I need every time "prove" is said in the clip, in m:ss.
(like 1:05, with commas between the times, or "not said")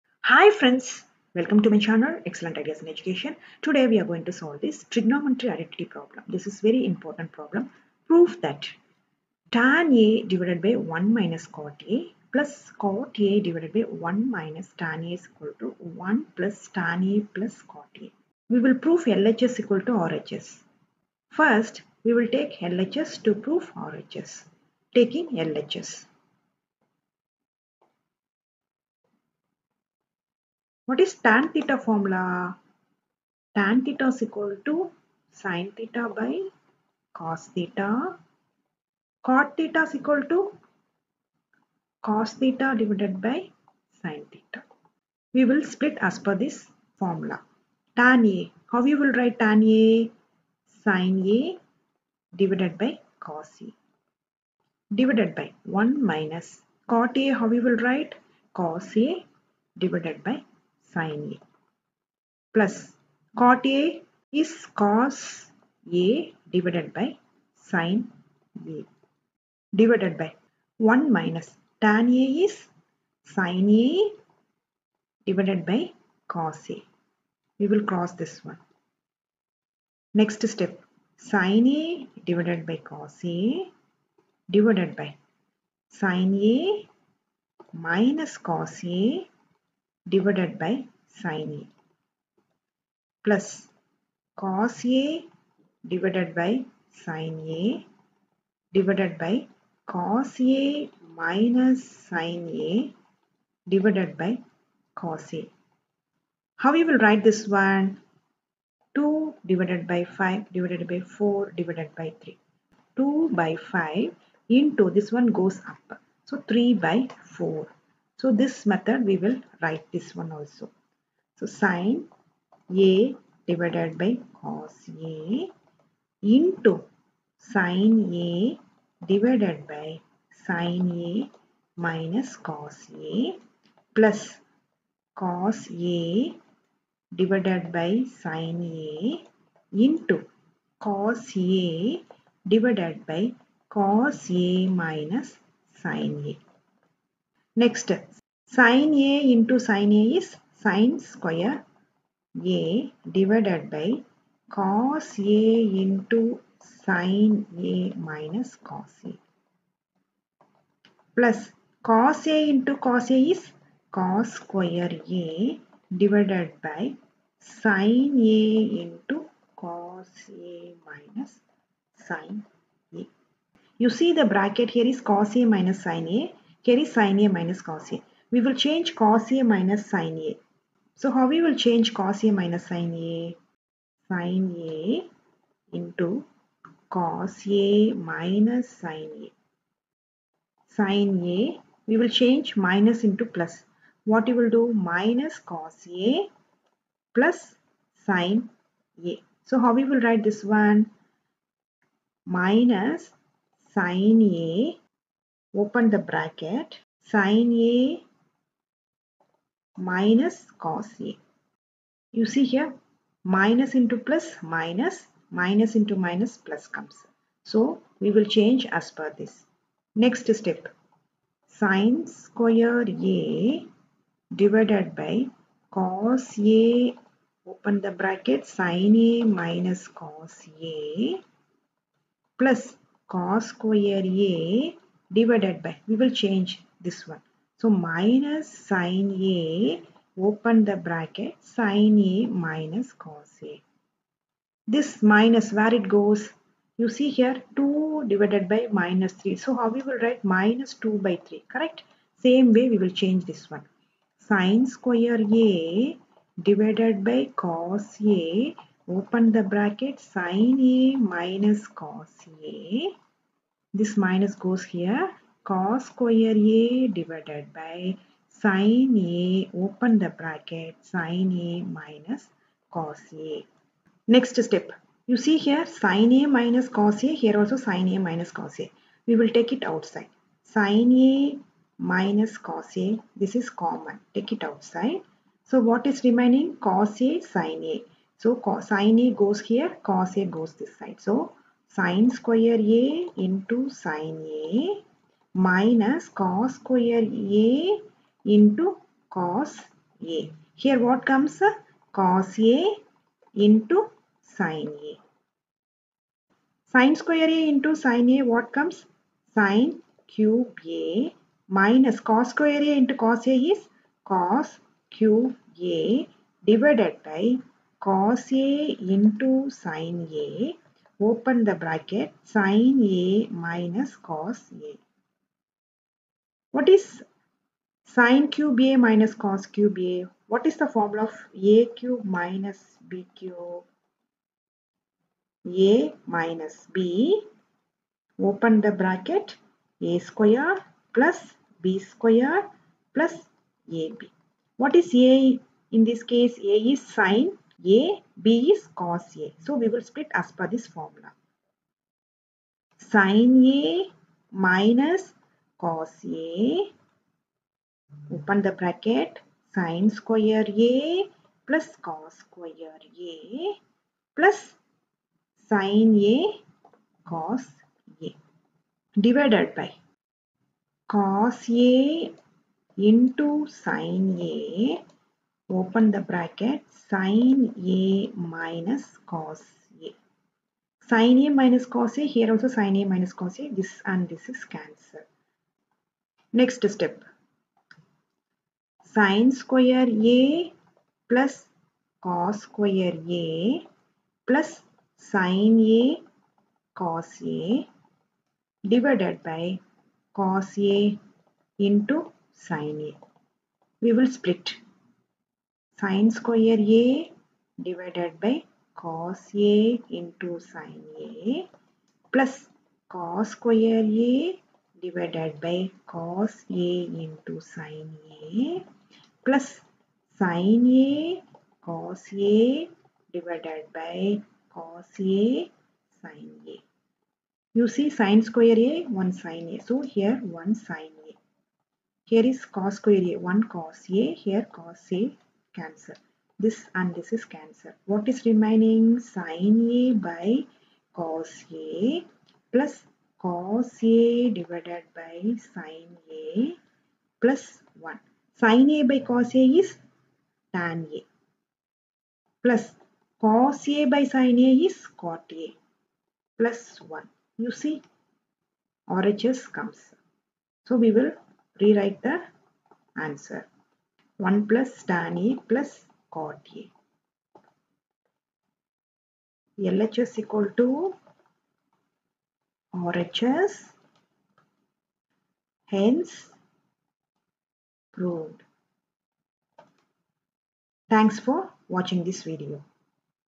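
0:08, 0:18, 0:23.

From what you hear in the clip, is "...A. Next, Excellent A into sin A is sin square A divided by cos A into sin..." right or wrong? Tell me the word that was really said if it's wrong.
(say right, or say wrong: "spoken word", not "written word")
wrong: "Sin", not "Excellent".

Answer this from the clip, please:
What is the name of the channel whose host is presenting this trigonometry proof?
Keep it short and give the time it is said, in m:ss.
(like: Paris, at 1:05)
Excellent Ideas in Education, at 0:02.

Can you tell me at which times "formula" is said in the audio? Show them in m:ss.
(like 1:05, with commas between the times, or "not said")
0:31, 0:46, 5:30, 5:50.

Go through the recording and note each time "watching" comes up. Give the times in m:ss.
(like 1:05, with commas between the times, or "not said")
8:01.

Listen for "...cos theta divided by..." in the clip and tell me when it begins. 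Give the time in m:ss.
0:42.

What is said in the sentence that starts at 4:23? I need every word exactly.
This minus goes here cos square a divided by sine a open the bracket sine a minus cos a.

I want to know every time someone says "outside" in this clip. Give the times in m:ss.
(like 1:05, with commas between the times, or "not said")
4:39, 4:44.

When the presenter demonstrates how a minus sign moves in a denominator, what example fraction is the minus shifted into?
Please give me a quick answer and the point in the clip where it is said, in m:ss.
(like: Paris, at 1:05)
2 divided by minus 3, at 4:07.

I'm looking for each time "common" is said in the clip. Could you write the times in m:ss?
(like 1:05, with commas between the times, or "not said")
4:43.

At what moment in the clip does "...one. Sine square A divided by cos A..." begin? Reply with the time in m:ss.
4:13.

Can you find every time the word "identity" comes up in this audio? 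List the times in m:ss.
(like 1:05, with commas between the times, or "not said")
0:05.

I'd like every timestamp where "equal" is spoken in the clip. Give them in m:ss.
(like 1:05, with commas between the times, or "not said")
0:15, 0:19, 0:34, 0:39, 7:50.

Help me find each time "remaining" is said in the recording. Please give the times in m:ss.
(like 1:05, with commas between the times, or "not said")
4:46, 7:18.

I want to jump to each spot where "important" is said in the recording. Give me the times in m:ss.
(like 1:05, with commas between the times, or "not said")
0:06.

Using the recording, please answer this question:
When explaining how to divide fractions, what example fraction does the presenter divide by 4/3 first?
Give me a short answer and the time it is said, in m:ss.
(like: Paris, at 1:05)
2/5, at 1:48.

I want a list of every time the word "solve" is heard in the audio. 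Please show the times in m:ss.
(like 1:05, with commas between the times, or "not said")
0:04.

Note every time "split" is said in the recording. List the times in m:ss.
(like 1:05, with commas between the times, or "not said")
0:45, 5:49, 6:44.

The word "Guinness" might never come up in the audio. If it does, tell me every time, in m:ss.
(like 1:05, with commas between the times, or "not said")
not said.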